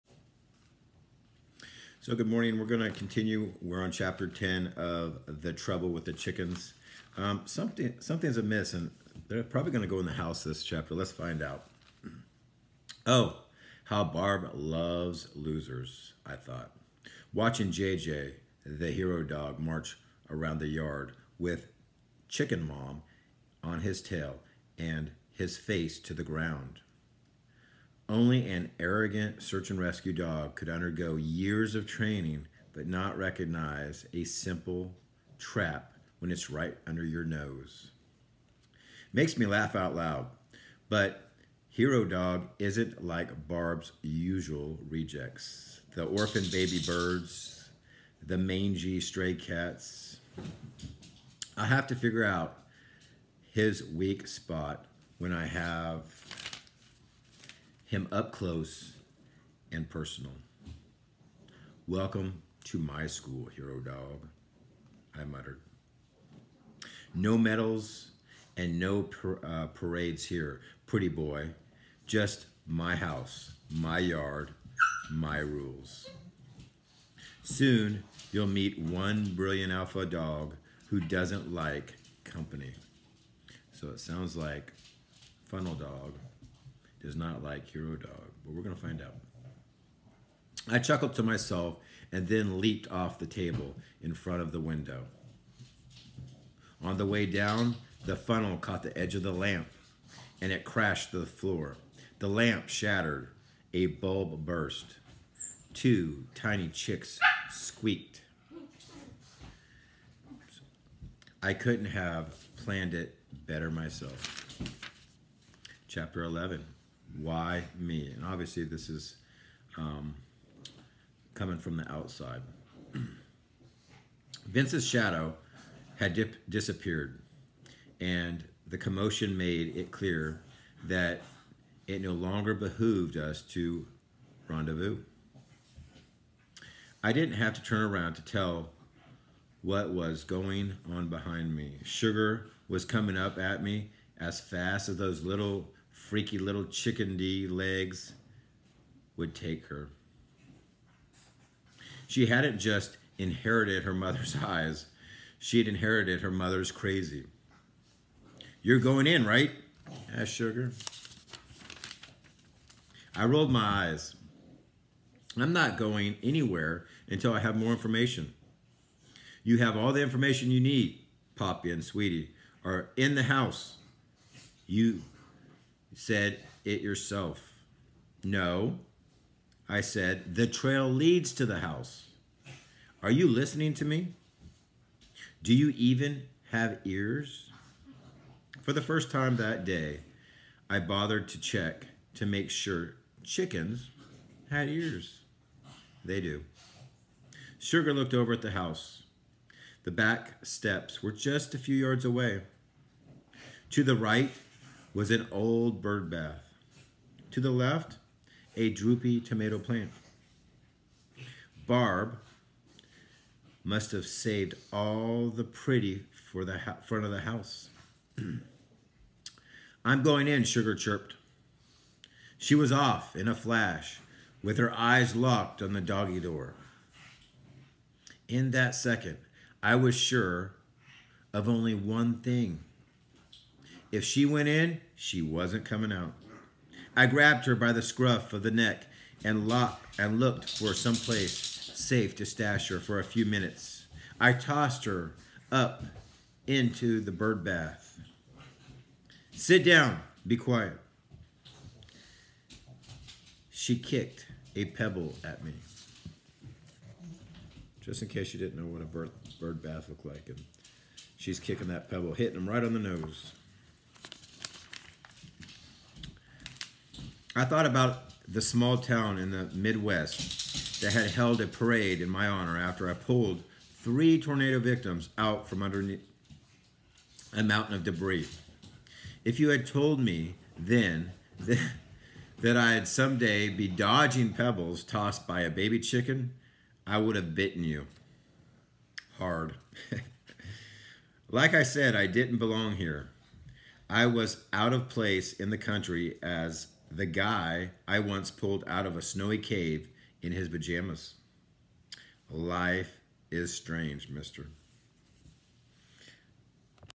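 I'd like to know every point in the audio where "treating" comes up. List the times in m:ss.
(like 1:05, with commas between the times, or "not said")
not said.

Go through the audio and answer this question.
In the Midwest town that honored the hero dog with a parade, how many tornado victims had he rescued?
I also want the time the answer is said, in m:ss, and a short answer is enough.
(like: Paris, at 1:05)
3, at 4:33.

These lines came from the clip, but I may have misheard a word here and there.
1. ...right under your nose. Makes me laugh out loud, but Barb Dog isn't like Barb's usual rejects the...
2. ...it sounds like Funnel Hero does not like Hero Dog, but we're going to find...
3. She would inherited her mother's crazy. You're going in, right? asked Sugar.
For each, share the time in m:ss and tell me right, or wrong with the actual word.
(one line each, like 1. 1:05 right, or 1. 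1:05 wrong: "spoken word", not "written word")
1. 0:36 wrong: "Hero", not "Barb"
2. 1:23 wrong: "Dog", not "Hero"
3. 2:35 right.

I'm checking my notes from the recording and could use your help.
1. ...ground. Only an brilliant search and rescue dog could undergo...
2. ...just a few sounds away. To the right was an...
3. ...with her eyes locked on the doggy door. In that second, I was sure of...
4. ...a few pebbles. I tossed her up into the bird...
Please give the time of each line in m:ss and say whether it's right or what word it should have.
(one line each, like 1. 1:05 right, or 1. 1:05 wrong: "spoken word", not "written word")
1. 0:26 wrong: "arrogant", not "brilliant"
2. 3:21 wrong: "yards", not "sounds"
3. 3:44 right
4. 4:02 wrong: "minutes", not "pebbles".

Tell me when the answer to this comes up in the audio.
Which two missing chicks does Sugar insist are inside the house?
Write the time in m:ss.
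2:51.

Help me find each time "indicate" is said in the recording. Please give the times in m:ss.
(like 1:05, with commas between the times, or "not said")
not said.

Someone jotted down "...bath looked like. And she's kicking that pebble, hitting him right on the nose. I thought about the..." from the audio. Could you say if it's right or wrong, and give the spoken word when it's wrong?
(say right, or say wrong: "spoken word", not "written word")
right.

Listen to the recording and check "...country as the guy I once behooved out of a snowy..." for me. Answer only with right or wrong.
wrong.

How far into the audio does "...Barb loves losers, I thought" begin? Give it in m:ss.
0:14.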